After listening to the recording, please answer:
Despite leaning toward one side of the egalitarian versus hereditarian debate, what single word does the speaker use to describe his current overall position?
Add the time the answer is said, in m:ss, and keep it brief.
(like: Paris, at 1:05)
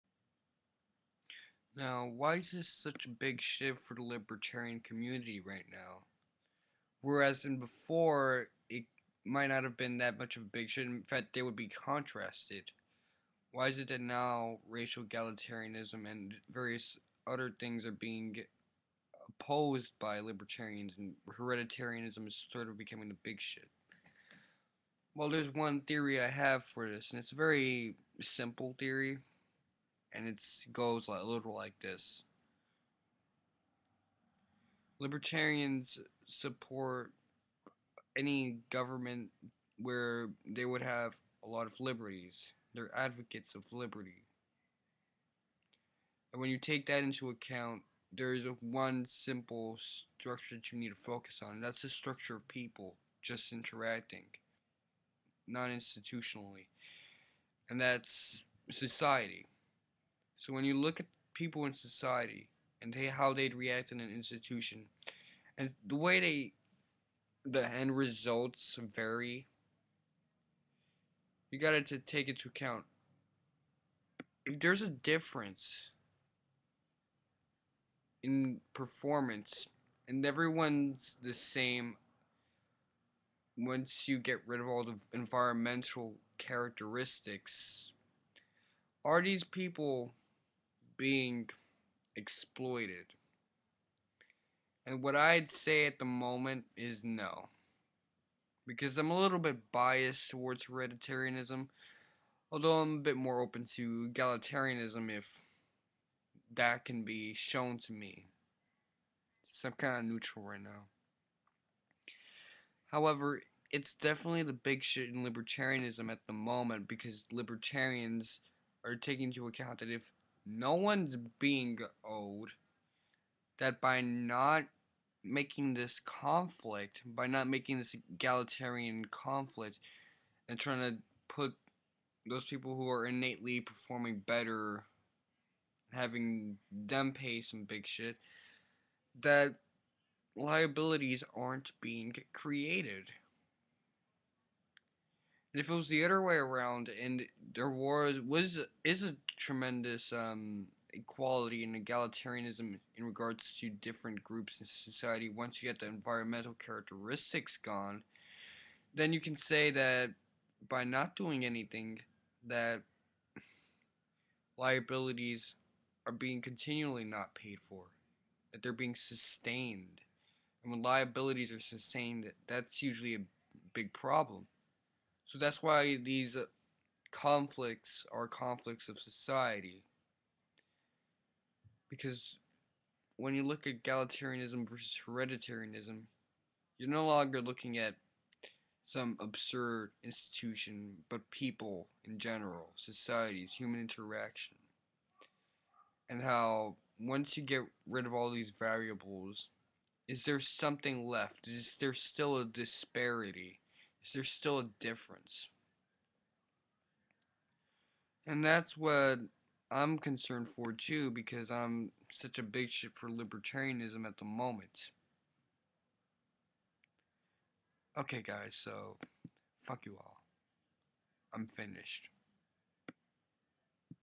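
neutral, at 1:50.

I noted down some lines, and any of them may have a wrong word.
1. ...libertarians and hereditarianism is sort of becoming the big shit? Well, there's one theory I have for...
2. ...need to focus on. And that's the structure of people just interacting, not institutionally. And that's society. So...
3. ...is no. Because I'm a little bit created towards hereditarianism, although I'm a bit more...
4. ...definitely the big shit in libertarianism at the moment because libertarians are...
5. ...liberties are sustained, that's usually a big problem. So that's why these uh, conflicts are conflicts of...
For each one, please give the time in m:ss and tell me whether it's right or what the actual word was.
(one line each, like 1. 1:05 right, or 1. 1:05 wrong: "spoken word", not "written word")
1. 0:20 right
2. 0:50 right
3. 1:36 wrong: "biased", not "created"
4. 1:53 right
5. 2:50 wrong: "liabilities", not "liberties".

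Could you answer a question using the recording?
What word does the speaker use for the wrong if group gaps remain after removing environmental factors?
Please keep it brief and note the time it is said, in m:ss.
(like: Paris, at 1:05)
exploited, at 1:32.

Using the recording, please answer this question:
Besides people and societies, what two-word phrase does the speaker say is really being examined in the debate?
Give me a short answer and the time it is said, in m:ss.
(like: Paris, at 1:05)
human interaction, at 3:13.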